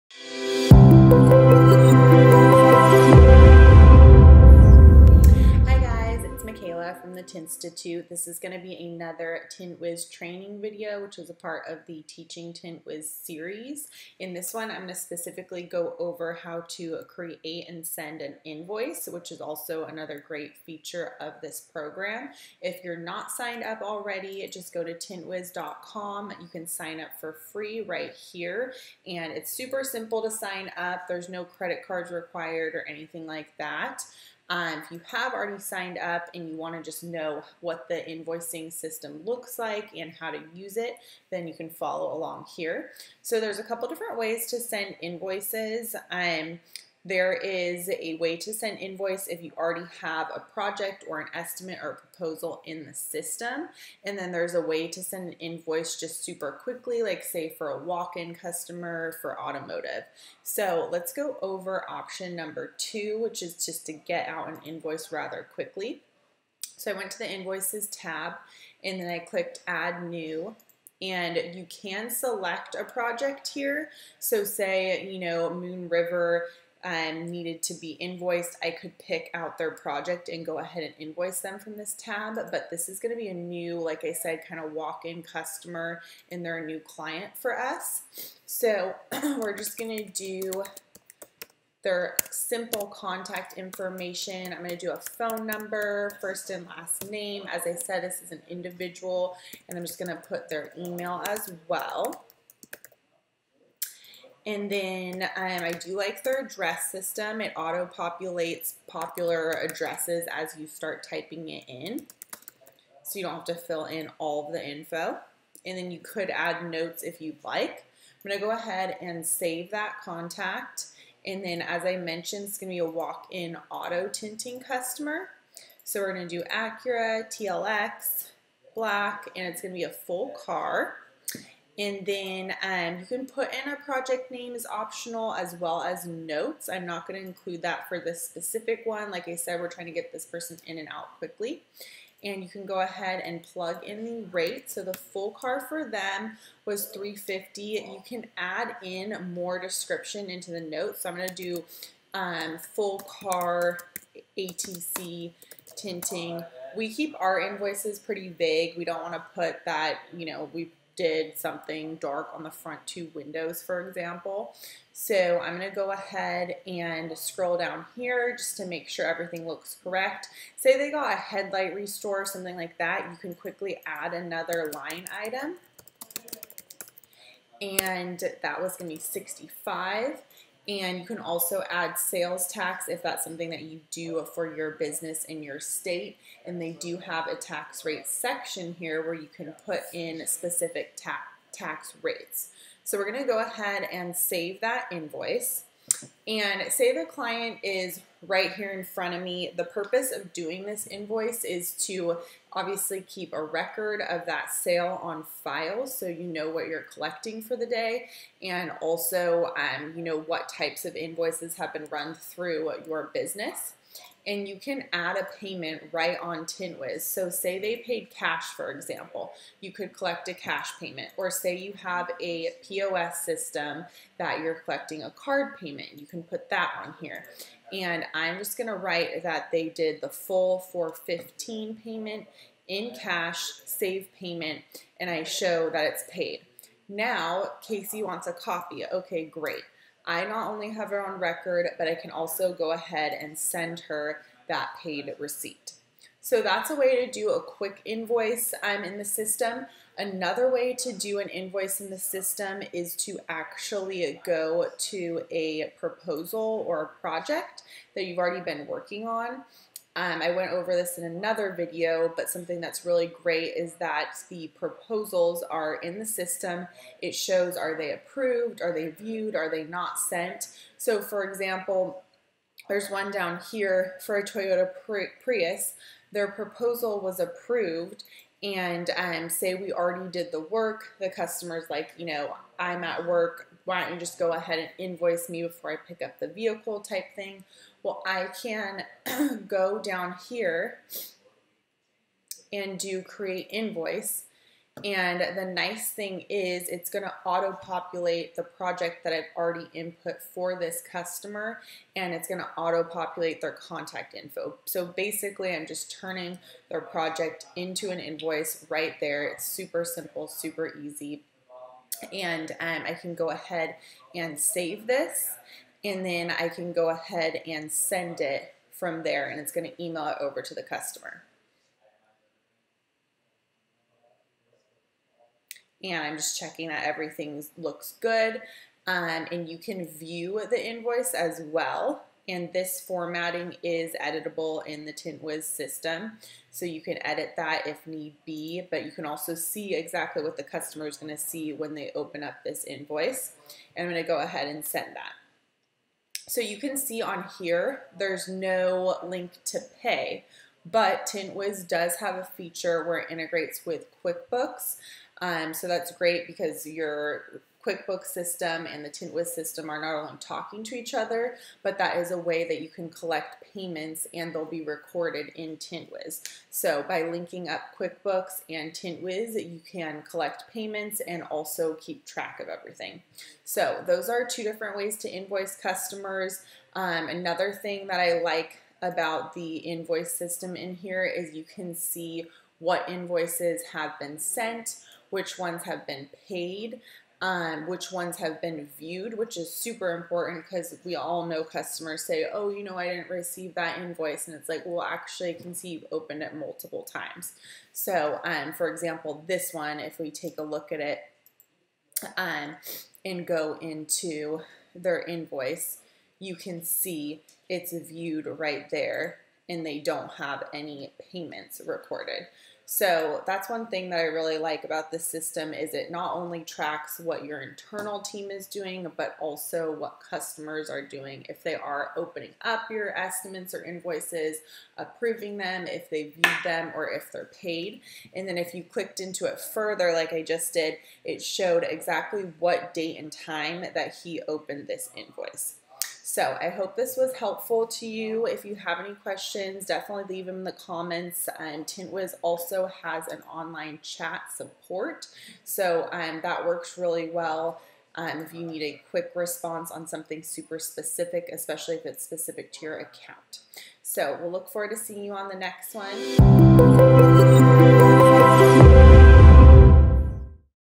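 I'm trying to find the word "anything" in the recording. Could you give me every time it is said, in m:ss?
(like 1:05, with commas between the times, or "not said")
0:32.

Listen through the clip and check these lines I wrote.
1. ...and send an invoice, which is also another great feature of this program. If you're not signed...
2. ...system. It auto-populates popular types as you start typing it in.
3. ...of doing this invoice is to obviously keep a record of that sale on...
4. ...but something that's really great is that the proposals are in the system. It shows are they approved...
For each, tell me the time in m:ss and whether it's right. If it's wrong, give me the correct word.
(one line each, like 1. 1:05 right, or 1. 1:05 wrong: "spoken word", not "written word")
1. 0:17 right
2. 1:46 wrong: "addresses", not "types"
3. 3:20 right
4. 4:22 right.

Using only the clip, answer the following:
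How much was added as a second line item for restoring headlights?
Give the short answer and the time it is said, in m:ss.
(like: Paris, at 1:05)
65, at 2:59.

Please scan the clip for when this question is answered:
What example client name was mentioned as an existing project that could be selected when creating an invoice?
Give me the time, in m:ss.
1:15.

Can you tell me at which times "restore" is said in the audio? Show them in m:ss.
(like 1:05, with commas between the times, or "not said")
2:51.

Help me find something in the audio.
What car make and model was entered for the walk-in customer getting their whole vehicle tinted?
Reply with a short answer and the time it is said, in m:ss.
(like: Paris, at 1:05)
Acura TLX, at 2:06.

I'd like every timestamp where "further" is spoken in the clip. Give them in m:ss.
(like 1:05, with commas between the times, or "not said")
7:09.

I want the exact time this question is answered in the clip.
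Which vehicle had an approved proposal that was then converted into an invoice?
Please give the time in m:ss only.
4:34.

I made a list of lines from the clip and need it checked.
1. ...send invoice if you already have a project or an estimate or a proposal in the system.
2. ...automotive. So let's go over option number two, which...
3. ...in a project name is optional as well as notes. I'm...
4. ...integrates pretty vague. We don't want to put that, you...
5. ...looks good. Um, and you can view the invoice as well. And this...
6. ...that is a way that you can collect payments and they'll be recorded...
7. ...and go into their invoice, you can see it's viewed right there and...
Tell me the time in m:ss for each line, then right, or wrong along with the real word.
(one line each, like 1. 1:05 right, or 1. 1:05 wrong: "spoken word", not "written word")
1. 0:48 right
2. 0:59 right
3. 2:13 right
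4. 2:37 wrong: "invoices", not "integrates"
5. 5:27 right
6. 6:01 right
7. 6:43 right.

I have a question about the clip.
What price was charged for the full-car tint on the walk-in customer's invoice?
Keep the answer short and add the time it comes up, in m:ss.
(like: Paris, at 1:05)
350, at 2:26.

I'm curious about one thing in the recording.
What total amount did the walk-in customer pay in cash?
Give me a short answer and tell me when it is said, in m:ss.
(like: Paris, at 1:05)
415, at 3:50.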